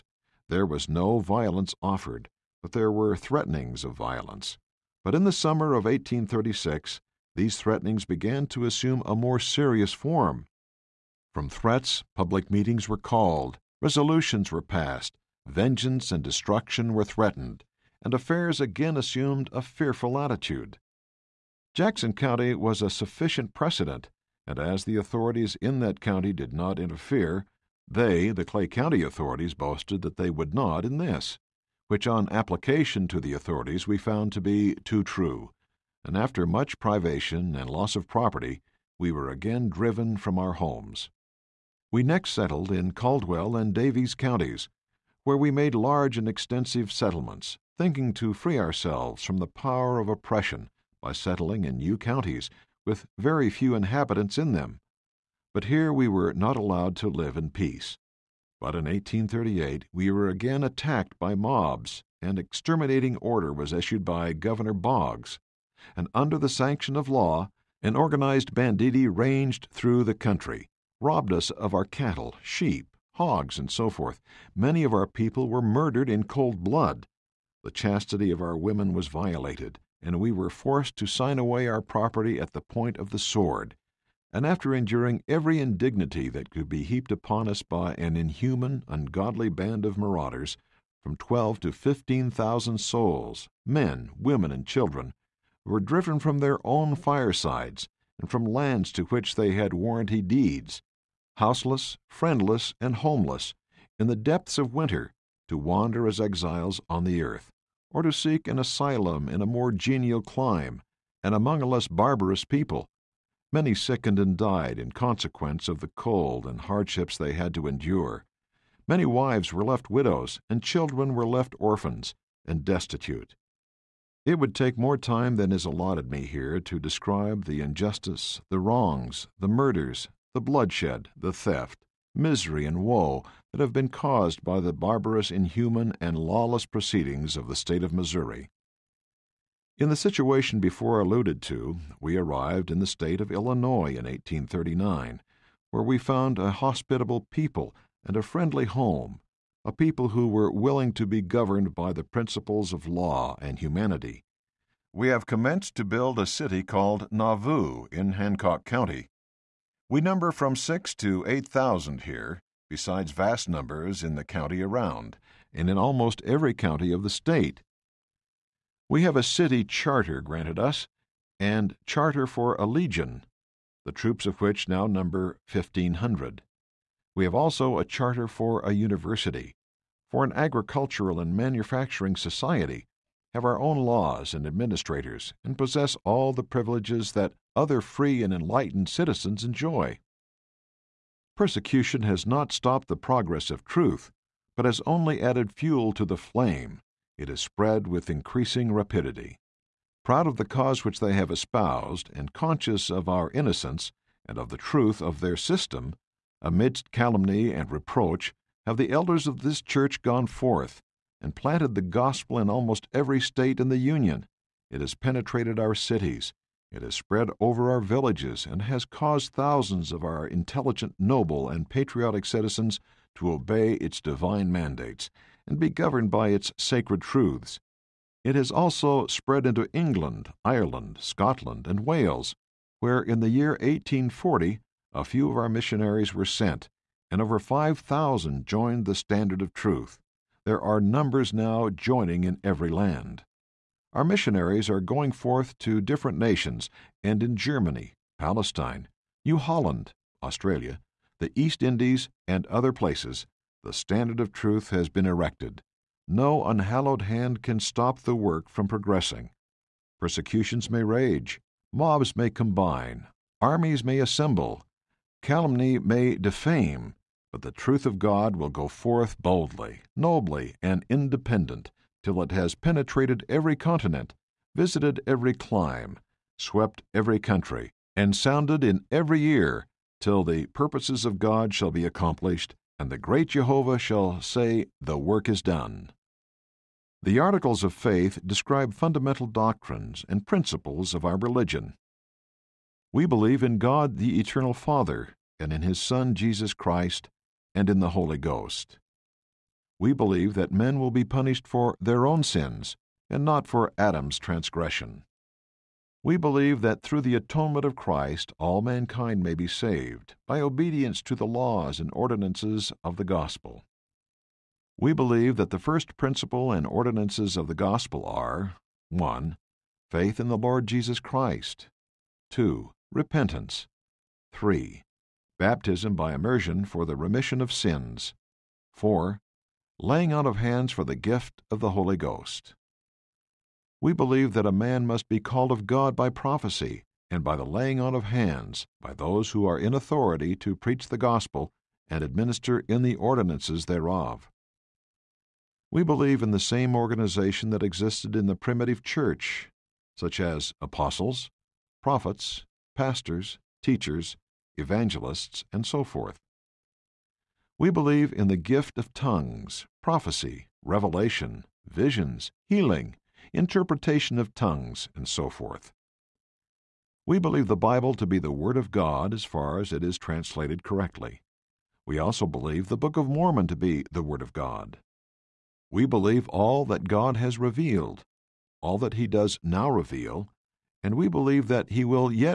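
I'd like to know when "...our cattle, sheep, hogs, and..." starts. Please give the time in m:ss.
1:11.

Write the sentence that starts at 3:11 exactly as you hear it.
Persecution has not stopped the progress of truth, but has only added fuel to the flame.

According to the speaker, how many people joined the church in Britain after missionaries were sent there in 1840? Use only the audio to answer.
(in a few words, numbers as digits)
over 5,000.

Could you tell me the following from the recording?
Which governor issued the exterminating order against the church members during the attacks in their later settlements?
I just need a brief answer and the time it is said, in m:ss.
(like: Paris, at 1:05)
Governor Boggs, at 1:04.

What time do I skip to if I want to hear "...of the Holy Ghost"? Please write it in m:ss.
5:31.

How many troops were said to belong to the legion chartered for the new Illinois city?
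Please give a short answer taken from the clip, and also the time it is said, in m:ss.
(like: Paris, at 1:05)
1,500, at 2:55.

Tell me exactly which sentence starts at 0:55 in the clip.
But here we were not allowed to live in peace.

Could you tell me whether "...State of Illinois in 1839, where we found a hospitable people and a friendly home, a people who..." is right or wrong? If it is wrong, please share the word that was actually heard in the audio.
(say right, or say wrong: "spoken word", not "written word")
right.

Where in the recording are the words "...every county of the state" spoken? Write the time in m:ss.
2:46.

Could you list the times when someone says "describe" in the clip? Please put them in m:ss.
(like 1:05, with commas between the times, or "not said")
2:06, 4:48.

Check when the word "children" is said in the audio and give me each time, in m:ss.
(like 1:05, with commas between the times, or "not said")
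1:34, 2:00.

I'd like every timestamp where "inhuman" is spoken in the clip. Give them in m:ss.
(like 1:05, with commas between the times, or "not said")
1:28, 2:15.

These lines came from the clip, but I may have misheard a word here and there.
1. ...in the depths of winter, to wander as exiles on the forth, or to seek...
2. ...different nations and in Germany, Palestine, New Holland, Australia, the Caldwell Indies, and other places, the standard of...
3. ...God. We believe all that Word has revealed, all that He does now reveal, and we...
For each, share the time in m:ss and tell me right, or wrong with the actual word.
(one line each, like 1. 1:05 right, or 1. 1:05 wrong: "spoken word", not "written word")
1. 1:43 wrong: "earth", not "forth"
2. 4:05 wrong: "East", not "Caldwell"
3. 6:14 wrong: "God", not "Word".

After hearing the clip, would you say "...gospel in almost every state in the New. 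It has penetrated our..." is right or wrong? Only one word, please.
wrong.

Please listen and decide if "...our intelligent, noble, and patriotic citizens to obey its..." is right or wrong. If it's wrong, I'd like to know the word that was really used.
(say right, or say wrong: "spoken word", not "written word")
right.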